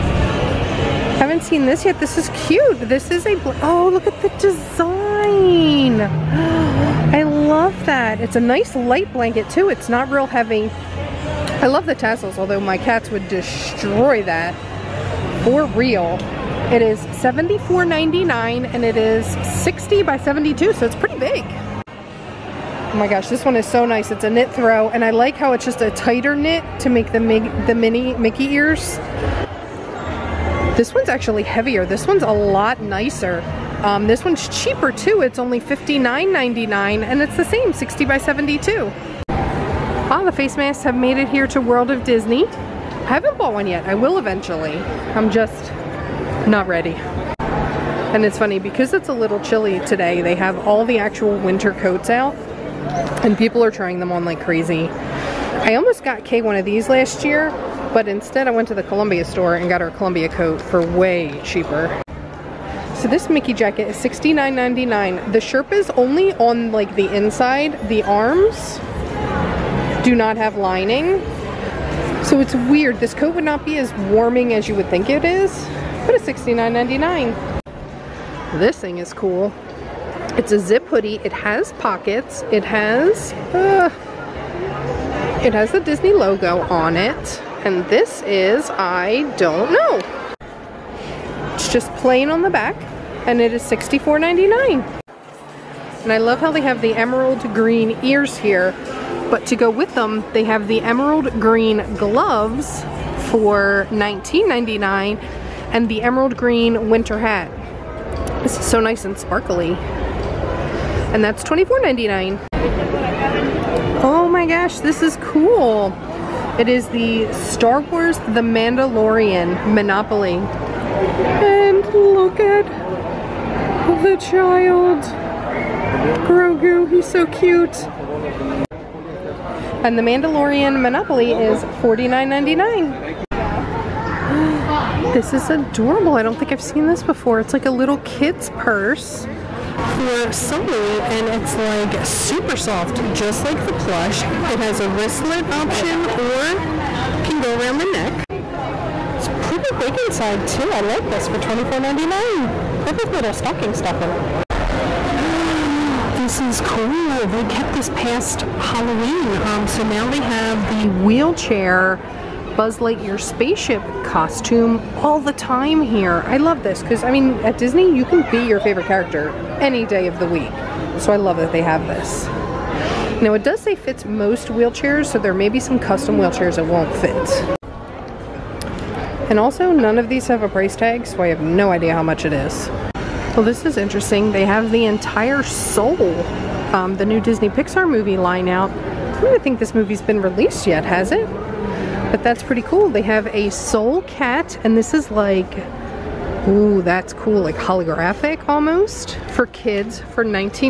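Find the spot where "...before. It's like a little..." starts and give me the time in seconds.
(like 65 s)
137 s.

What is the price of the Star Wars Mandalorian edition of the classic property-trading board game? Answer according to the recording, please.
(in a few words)
$49.99.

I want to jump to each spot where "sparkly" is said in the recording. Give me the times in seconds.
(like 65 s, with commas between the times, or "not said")
109 s.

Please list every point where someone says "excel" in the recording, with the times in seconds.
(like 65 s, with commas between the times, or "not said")
not said.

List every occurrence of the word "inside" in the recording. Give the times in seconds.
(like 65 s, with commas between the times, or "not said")
67 s, 149 s.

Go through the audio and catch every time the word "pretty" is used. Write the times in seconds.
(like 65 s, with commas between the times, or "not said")
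20 s, 149 s, 192 s.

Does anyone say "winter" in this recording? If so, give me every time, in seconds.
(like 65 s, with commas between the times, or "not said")
51 s, 106 s.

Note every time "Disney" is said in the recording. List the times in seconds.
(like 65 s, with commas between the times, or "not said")
42 s, 85 s, 167 s, 187 s.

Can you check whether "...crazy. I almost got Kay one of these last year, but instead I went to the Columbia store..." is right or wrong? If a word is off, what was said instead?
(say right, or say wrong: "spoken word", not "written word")
right.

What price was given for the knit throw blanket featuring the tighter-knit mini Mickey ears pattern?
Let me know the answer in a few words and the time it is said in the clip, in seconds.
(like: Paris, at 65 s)
$59.99, at 35 s.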